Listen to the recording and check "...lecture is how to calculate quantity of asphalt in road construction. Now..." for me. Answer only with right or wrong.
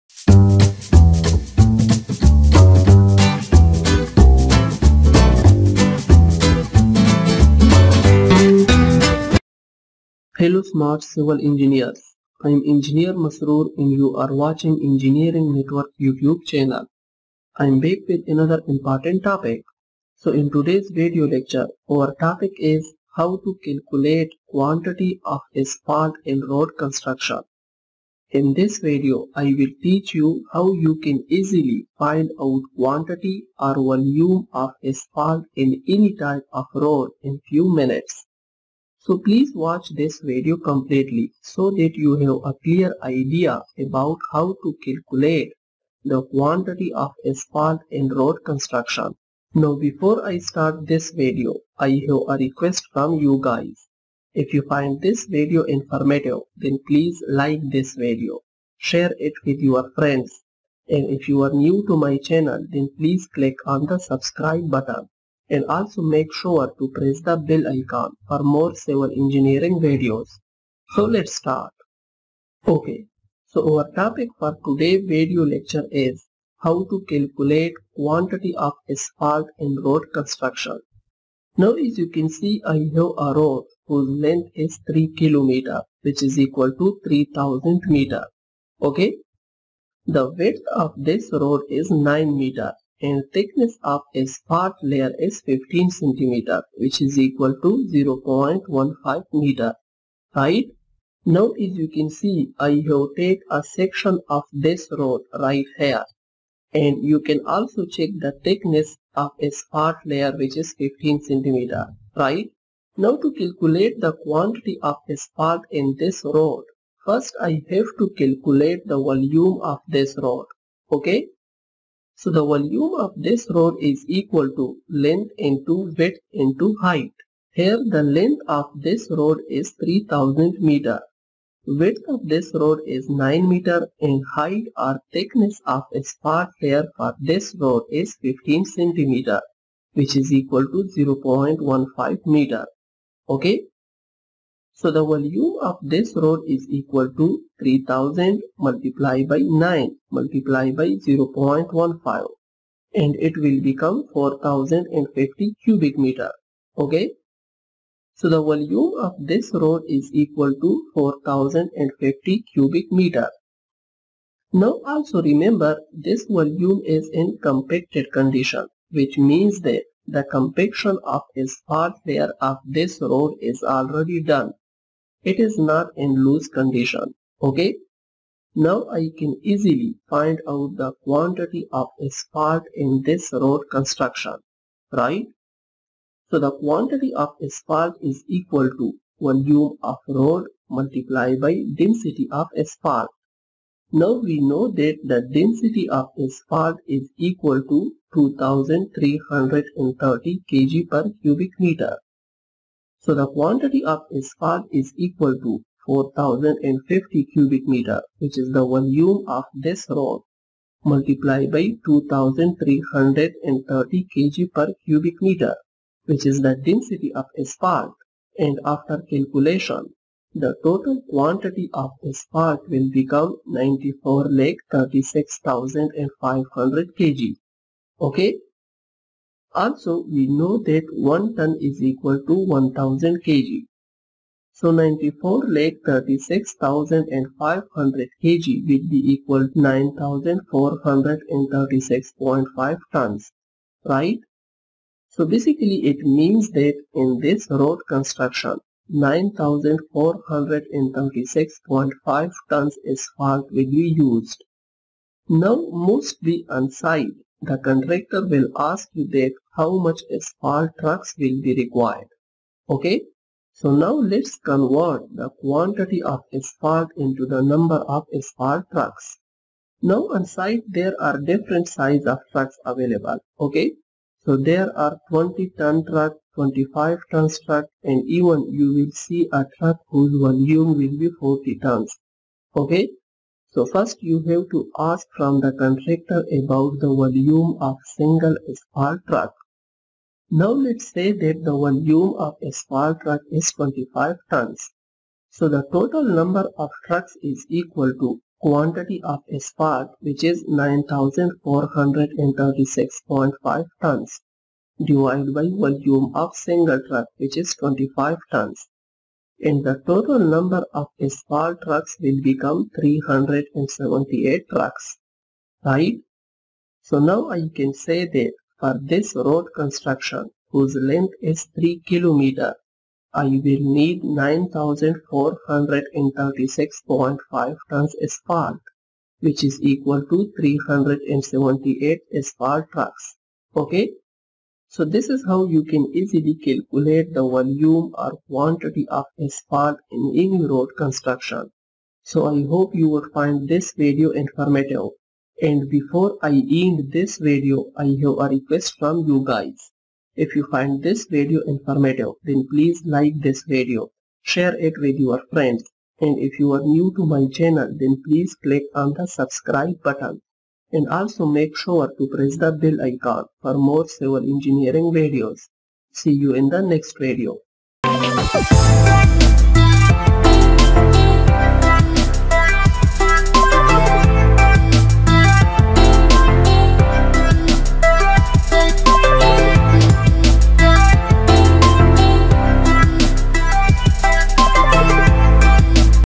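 right.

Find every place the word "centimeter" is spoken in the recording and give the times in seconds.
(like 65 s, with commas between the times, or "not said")
95 s, 111 s, 138 s.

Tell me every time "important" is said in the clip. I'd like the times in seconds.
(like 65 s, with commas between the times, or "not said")
18 s.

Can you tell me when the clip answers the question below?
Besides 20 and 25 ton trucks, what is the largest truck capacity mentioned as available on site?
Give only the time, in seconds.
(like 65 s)
281 s.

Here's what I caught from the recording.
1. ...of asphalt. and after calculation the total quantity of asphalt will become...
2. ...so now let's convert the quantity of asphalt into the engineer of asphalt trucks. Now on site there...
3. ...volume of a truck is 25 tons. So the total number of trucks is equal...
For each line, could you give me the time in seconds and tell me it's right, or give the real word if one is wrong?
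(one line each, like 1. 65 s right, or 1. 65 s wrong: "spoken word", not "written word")
1. 217 s right
2. 263 s wrong: "number", not "engineer"
3. 291 s right.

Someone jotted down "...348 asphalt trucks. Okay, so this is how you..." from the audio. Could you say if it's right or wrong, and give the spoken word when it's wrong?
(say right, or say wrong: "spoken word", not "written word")
wrong: "378", not "348".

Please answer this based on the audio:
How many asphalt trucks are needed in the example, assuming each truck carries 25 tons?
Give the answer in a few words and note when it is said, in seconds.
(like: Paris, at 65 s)
378, at 312 s.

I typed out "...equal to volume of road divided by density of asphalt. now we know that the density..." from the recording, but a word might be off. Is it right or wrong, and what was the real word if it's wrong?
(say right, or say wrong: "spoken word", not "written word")
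wrong: "multiplied", not "divided".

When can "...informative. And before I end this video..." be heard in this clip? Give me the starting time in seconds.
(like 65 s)
344 s.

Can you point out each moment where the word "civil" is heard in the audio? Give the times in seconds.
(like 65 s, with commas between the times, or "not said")
11 s, 68 s, 363 s.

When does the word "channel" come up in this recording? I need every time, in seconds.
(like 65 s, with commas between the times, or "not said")
16 s, 62 s, 357 s.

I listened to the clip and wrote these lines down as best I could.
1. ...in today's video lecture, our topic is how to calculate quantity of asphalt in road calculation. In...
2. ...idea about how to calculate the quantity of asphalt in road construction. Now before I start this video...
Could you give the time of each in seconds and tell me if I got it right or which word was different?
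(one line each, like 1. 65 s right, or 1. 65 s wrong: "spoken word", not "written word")
1. 20 s wrong: "construction", not "calculation"
2. 43 s right.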